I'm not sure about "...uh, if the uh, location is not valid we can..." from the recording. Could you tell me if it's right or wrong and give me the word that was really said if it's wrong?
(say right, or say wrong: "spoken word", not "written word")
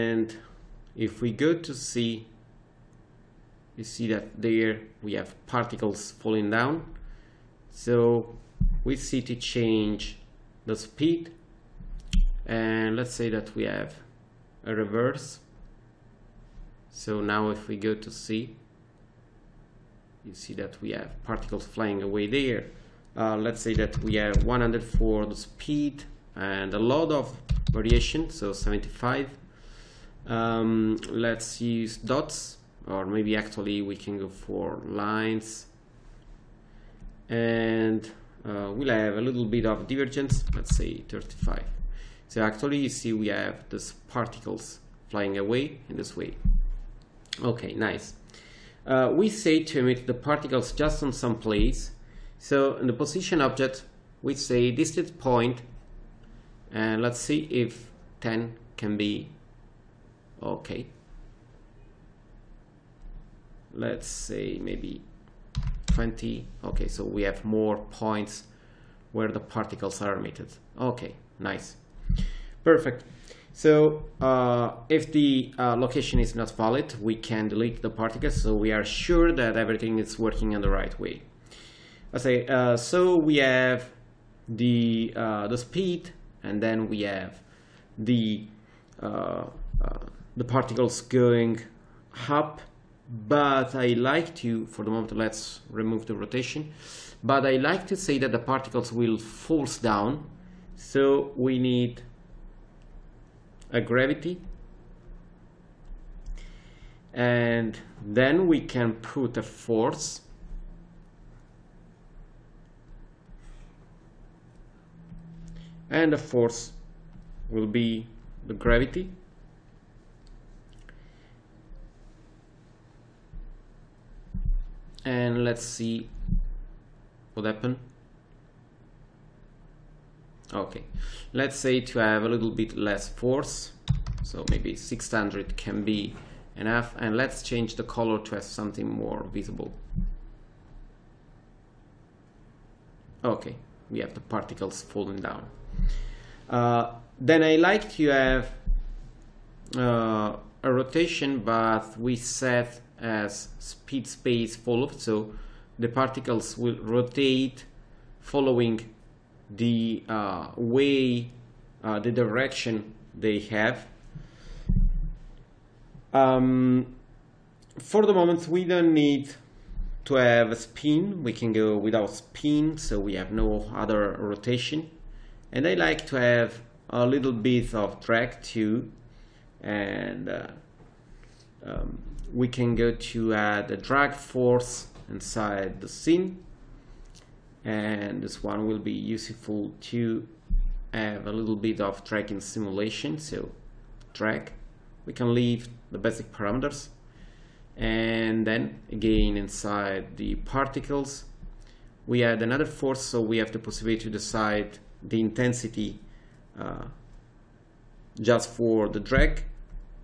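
right.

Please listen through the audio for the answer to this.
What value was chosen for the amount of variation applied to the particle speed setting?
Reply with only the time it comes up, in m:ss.
0:28.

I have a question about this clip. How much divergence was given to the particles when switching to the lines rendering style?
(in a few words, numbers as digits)
35.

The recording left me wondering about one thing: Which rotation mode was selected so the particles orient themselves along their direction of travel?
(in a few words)
speed space follow.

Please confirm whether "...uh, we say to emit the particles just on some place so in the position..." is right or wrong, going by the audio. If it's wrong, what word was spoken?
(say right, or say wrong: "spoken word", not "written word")
right.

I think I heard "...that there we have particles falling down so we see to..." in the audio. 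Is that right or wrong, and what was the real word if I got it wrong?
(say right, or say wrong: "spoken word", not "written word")
right.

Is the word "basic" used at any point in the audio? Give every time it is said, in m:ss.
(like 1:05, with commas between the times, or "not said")
3:15.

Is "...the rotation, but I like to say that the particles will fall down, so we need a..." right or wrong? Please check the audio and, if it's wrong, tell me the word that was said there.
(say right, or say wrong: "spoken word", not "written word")
right.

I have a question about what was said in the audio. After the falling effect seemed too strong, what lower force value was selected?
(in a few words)
600.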